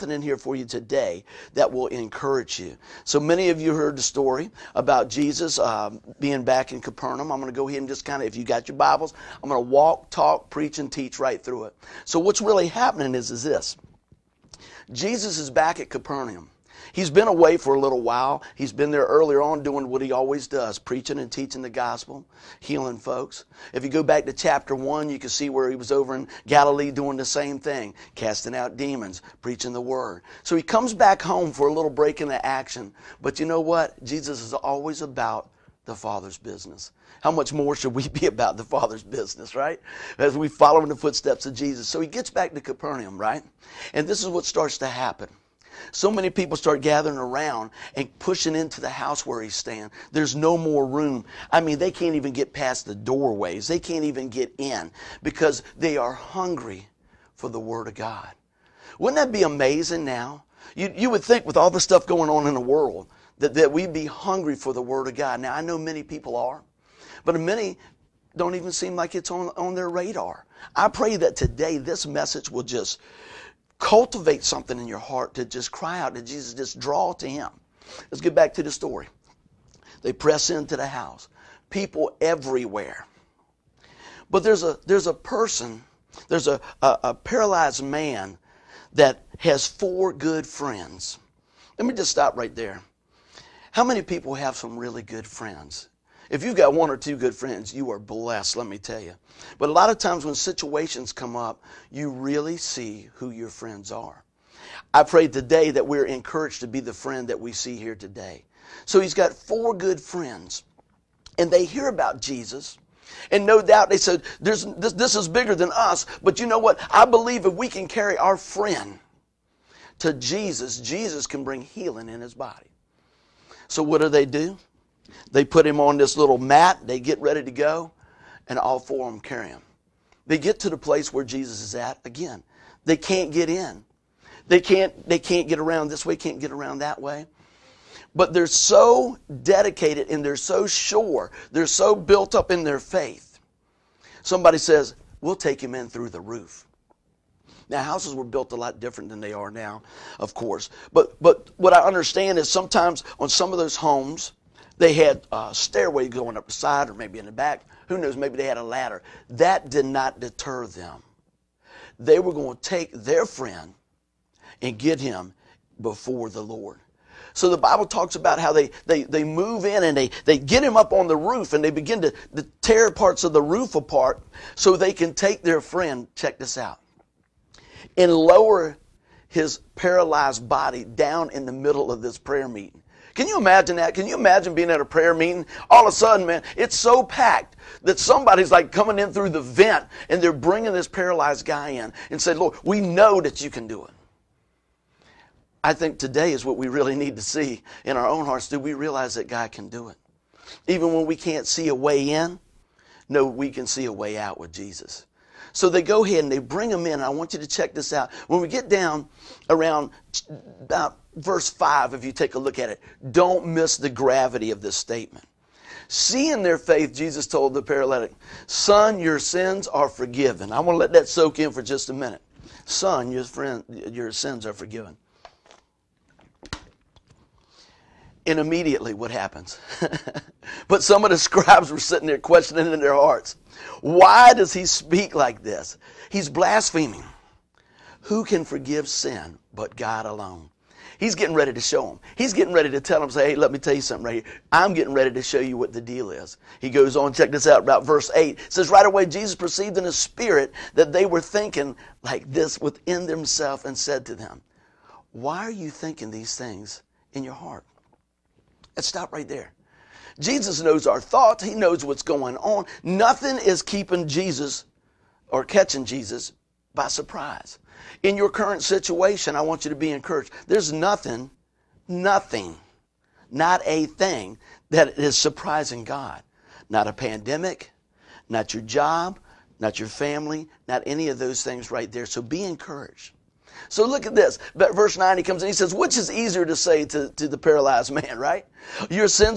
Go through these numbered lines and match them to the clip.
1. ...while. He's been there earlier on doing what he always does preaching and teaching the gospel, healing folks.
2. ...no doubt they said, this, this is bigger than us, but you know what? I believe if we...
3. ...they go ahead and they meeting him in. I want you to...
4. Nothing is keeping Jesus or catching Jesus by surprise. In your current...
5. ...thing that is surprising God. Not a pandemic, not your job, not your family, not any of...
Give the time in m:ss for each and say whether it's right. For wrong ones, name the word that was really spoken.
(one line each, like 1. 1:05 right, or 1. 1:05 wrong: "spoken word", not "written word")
1. 0:18 right
2. 1:53 right
3. 3:25 wrong: "bring", not "meeting"
4. 4:22 right
5. 4:33 right.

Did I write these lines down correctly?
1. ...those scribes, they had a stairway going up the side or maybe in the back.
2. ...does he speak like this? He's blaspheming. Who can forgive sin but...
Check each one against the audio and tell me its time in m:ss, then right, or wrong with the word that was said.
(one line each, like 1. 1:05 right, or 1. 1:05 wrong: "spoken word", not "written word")
1. 2:33 wrong: "homes", not "scribes"
2. 3:54 right.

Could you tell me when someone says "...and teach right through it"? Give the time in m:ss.
0:10.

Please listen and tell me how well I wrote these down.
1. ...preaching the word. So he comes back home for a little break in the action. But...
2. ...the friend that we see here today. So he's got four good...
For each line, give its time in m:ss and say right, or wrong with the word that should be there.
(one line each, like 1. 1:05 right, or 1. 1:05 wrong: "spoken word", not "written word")
1. 0:29 right
2. 1:46 right.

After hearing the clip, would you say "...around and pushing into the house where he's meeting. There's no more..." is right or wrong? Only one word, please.
wrong.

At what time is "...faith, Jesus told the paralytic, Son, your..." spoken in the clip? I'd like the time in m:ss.
3:36.